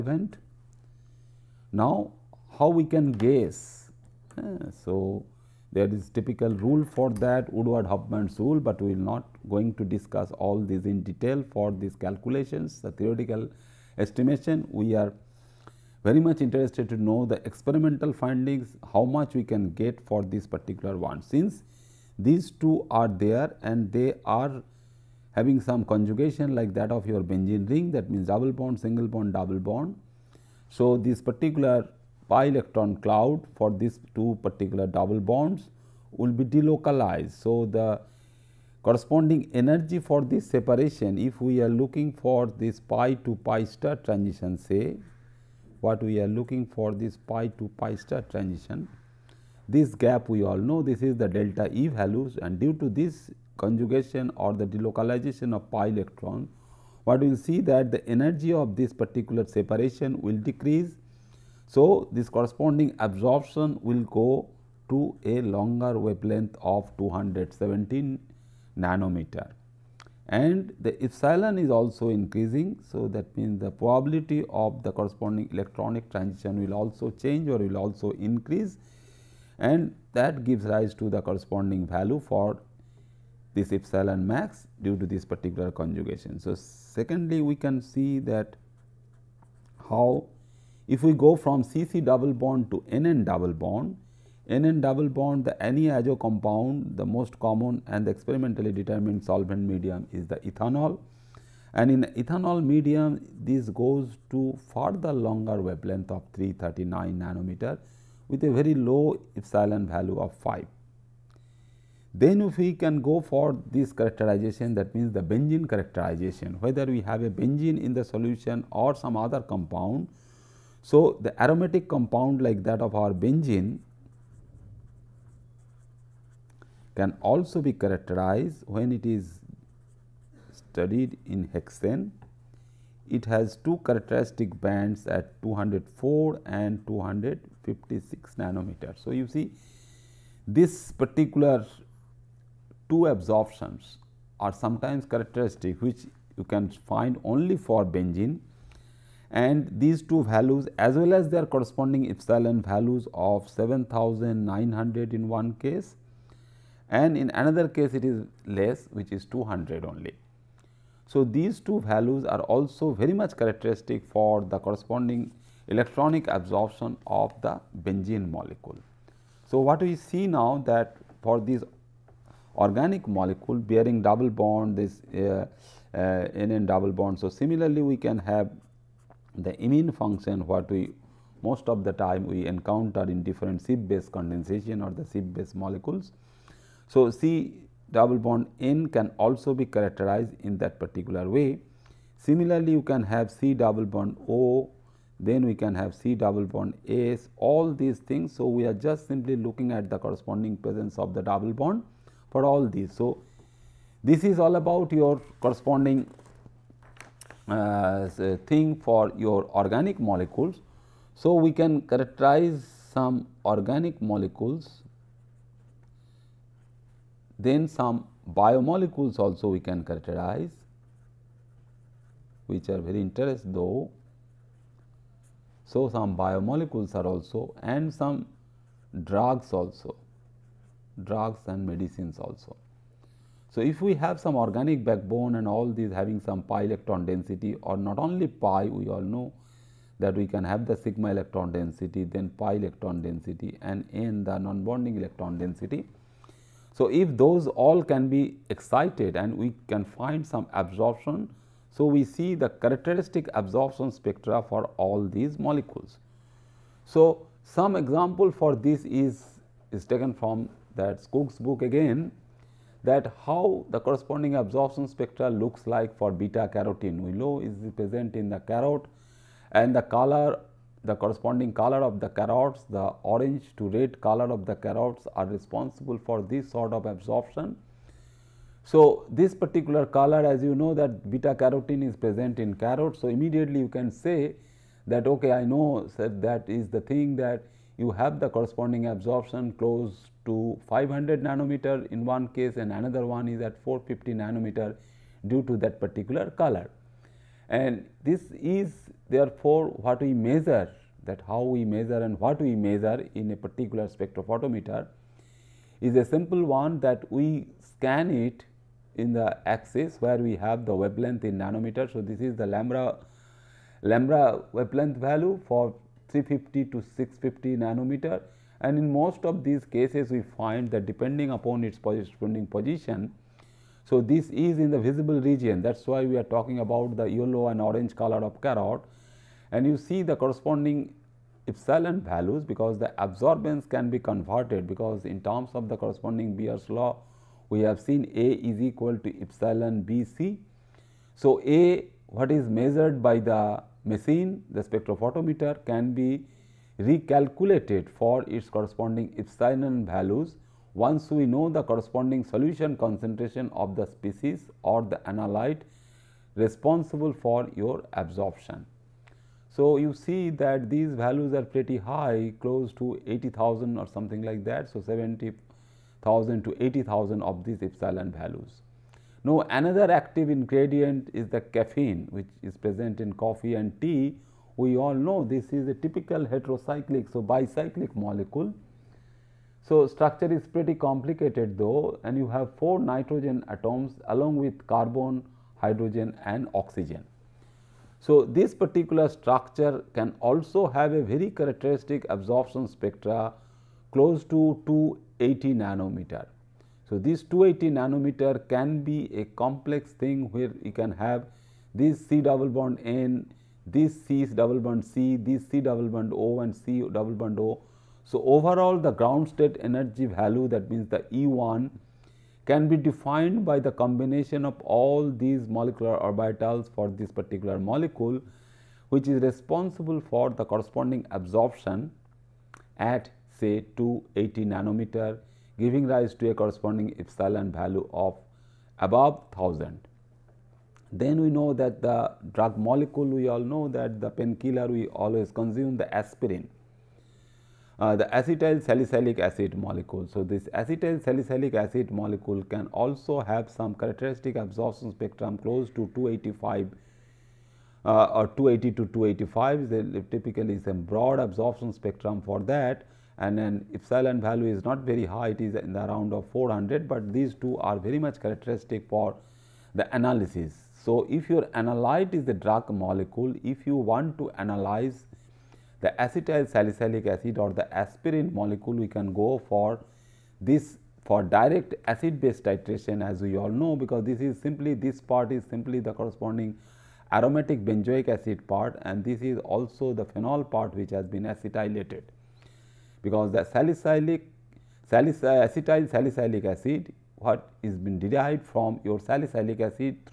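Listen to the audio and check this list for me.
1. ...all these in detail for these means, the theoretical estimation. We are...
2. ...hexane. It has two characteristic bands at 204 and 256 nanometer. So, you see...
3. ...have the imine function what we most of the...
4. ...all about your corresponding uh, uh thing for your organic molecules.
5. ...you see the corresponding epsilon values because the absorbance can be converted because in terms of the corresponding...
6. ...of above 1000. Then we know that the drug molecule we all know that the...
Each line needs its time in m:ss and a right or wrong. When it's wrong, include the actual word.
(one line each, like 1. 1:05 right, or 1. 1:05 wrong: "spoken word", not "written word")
1. 0:10 wrong: "calculations", not "means"
2. 2:11 right
3. 2:58 right
4. 3:24 right
5. 5:29 right
6. 7:07 right.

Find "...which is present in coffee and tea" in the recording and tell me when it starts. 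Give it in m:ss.
6:12.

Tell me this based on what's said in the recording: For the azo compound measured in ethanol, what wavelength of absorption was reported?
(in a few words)
339 nm.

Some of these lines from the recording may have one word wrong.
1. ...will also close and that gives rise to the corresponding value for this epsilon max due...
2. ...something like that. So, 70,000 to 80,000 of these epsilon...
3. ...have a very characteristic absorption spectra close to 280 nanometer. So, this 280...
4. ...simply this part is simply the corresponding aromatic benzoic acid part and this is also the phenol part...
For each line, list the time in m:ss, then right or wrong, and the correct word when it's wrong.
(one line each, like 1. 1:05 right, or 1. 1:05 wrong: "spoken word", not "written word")
1. 1:17 wrong: "increase", not "close"
2. 6:03 right
3. 6:30 right
4. 7:54 right.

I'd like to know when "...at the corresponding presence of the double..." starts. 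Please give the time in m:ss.
3:19.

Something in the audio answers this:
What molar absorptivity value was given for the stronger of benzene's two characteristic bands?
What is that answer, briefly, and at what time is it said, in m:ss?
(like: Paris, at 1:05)
7900, at 2:33.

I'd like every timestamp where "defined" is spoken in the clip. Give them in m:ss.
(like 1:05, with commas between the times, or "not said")
6:52.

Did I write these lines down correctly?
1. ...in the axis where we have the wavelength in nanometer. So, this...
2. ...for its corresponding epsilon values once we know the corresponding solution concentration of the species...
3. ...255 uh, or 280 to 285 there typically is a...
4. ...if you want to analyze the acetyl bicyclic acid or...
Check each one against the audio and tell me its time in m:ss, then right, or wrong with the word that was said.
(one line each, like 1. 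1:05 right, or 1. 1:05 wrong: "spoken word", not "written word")
1. 5:08 right
2. 5:47 right
3. 7:25 wrong: "285", not "255"
4. 7:43 wrong: "salicylic", not "bicyclic".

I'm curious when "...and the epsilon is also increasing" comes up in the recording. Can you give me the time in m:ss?
1:10.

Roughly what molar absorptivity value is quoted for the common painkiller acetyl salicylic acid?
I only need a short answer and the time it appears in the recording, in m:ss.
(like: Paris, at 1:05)
400, at 7:36.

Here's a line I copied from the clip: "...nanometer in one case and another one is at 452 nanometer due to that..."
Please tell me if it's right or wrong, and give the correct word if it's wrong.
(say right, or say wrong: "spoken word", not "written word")
wrong: "450", not "452".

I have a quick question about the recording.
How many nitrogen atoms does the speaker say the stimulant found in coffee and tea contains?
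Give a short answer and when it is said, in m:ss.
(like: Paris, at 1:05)
4, at 6:22.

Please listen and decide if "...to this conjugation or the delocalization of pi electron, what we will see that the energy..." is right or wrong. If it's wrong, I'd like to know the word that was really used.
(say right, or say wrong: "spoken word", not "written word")
right.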